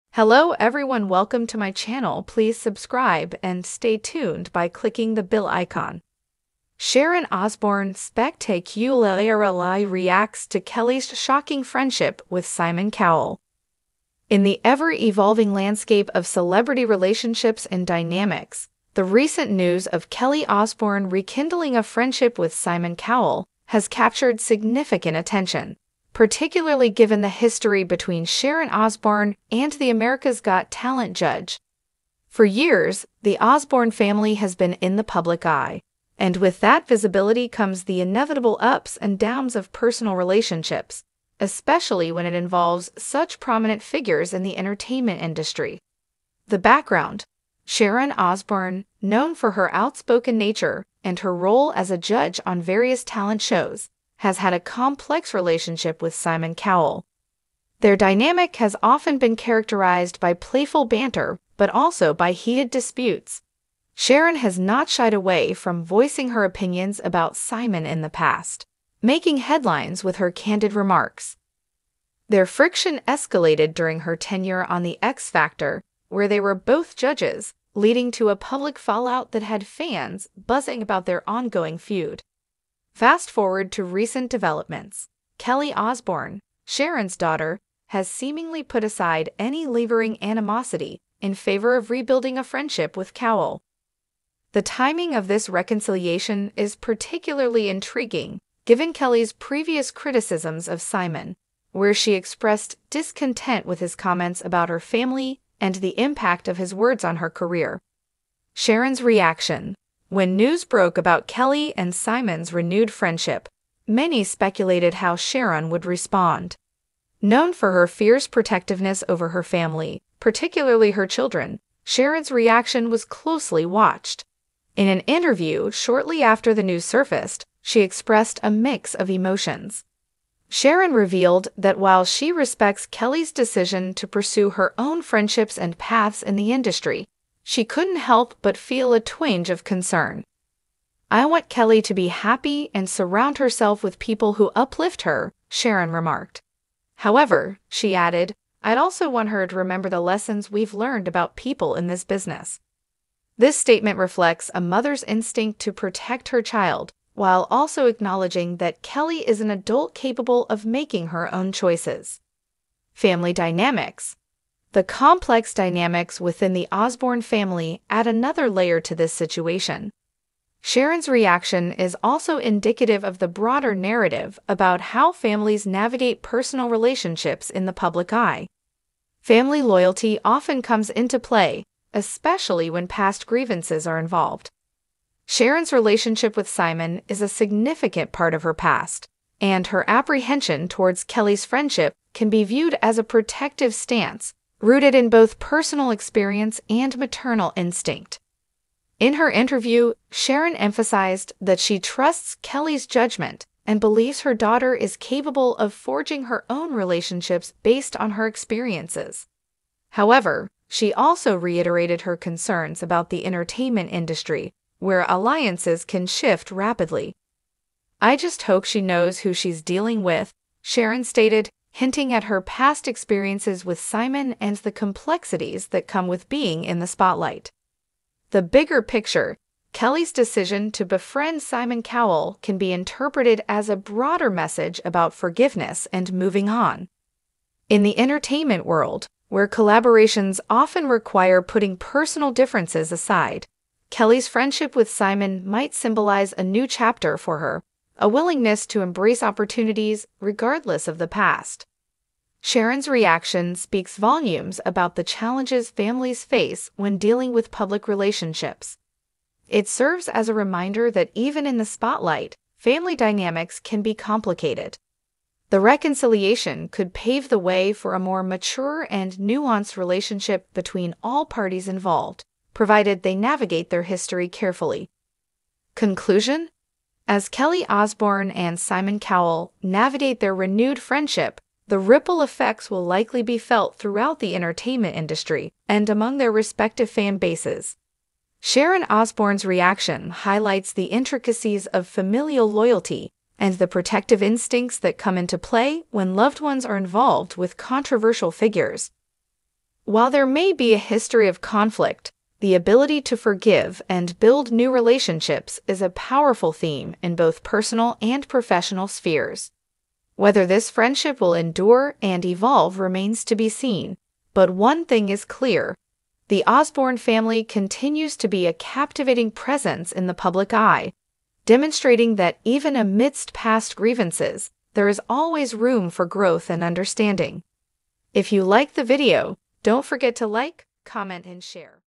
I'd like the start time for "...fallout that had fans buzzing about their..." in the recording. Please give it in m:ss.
1:18.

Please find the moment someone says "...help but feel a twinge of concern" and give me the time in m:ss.
2:17.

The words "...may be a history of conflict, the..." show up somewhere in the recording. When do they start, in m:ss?
5:00.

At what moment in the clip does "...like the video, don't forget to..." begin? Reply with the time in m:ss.
5:28.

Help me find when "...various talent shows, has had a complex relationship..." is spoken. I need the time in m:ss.
0:52.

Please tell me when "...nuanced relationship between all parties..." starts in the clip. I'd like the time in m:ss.
4:29.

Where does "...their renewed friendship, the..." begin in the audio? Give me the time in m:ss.
4:40.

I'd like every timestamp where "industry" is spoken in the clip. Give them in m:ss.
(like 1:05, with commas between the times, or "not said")
0:45, 2:16, 3:33, 4:44.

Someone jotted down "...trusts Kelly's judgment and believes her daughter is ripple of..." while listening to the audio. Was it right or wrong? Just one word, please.
wrong.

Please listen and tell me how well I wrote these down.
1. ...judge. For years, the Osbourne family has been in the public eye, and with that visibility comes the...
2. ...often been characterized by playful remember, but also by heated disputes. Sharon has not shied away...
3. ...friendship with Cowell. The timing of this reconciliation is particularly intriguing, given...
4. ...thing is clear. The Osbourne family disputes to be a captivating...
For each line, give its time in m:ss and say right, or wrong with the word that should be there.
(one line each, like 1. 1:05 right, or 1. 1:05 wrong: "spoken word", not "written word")
1. 0:31 right
2. 0:58 wrong: "banter", not "remember"
3. 1:32 right
4. 5:14 wrong: "continues", not "disputes".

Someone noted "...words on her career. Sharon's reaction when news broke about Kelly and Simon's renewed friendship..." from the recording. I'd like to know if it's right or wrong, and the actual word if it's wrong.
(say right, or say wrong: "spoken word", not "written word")
right.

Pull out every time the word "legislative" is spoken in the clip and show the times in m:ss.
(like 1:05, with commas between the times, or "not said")
not said.